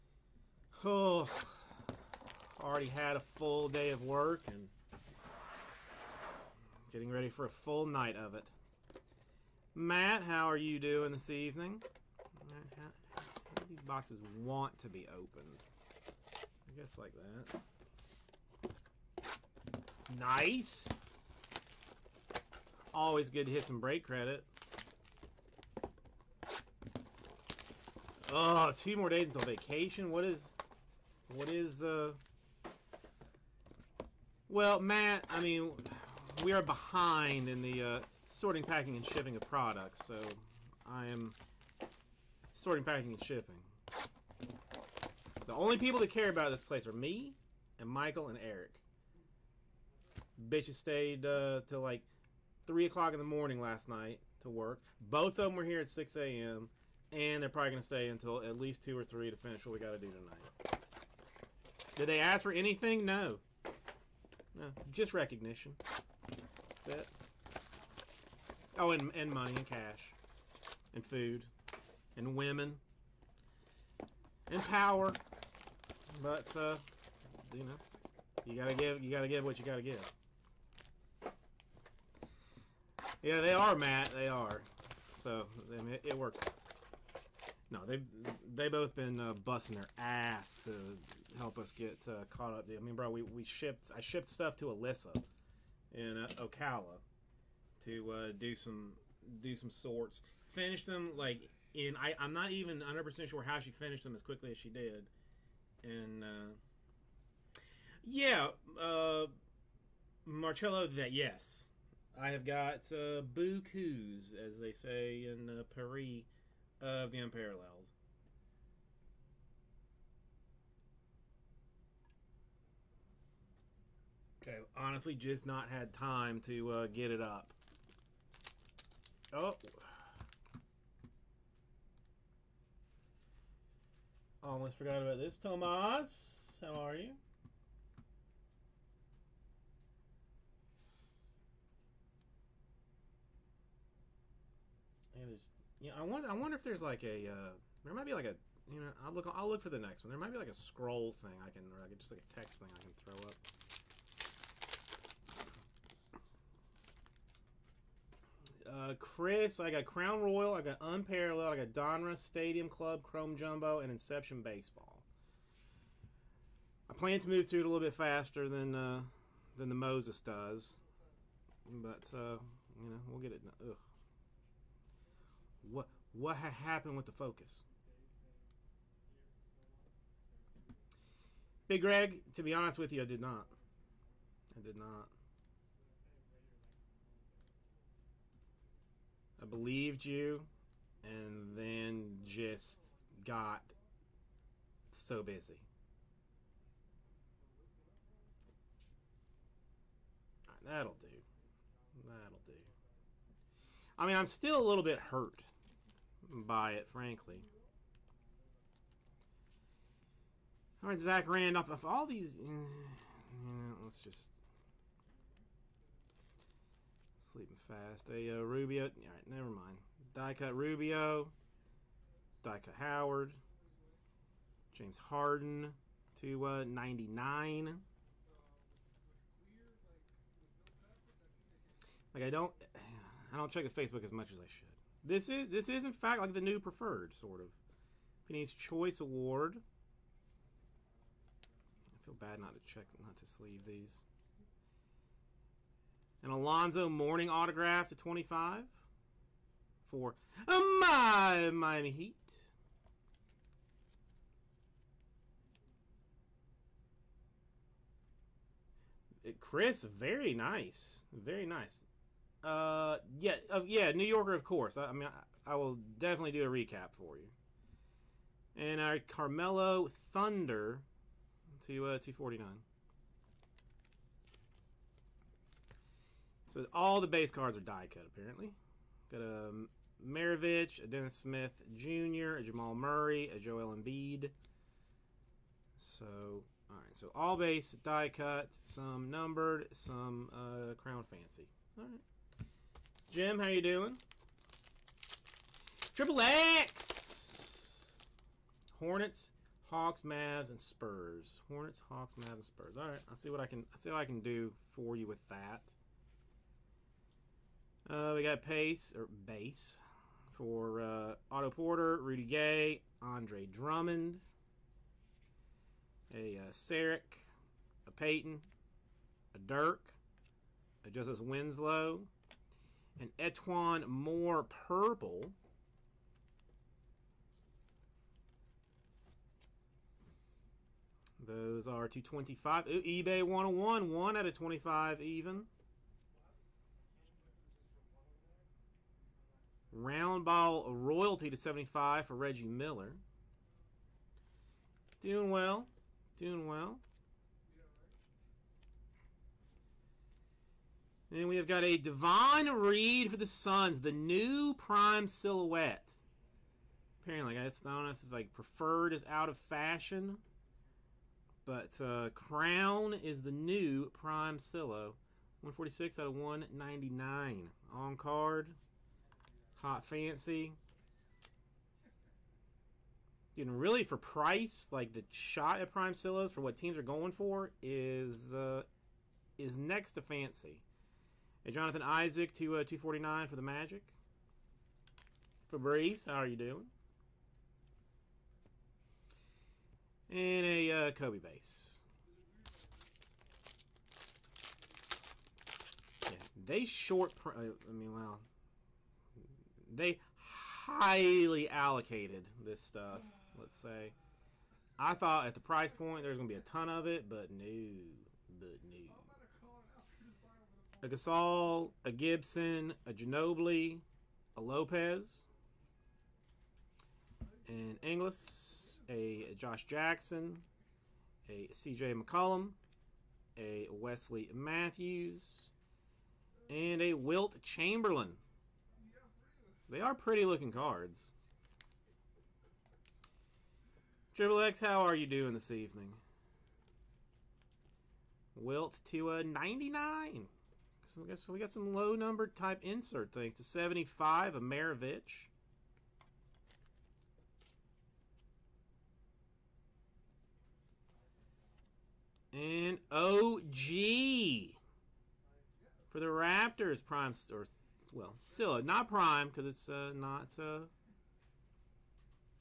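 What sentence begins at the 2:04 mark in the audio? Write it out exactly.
Okay, honestly, just not had time to uh, get it up.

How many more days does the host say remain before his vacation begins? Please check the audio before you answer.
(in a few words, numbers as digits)
2.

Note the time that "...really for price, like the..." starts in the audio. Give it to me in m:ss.
6:13.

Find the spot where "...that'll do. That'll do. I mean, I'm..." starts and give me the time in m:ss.
3:20.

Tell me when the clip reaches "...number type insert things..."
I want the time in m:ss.
7:21.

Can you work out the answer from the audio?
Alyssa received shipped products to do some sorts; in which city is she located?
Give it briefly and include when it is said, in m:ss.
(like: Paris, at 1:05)
Ocala, at 1:36.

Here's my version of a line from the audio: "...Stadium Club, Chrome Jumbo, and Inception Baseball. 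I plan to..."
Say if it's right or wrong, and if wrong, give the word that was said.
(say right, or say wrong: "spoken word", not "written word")
right.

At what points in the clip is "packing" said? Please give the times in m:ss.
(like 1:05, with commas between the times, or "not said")
0:38, 0:42.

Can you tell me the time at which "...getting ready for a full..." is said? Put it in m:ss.
0:06.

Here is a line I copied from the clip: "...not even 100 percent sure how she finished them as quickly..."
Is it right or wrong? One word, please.
right.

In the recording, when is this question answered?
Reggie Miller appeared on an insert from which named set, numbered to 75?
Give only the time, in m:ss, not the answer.
5:39.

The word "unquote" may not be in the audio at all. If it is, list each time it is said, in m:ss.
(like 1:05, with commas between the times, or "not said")
not said.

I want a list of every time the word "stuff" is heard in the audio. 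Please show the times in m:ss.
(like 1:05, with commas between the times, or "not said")
1:34, 6:42.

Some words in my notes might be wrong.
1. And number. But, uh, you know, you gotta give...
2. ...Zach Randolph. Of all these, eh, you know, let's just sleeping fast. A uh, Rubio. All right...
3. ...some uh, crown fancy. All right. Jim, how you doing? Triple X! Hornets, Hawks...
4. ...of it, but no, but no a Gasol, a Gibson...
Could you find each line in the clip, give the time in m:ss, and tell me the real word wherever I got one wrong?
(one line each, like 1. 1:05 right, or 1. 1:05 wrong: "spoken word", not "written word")
1. 1:14 wrong: "power", not "number"
2. 3:30 right
3. 4:49 right
4. 6:46 right.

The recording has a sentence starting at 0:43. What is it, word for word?
The only people that care about this place are me and Michael and Eric.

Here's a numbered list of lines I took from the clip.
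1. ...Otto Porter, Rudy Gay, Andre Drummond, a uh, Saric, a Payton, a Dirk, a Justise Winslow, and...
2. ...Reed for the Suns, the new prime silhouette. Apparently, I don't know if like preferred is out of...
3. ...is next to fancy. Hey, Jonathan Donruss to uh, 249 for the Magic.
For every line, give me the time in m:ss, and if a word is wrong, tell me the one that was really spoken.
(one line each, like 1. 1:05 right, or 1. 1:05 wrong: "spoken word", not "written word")
1. 5:11 right
2. 5:52 right
3. 6:19 wrong: "Isaac", not "Donruss".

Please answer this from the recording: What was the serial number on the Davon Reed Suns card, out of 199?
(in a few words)
146.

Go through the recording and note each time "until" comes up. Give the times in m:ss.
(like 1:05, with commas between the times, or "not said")
0:29, 0:58.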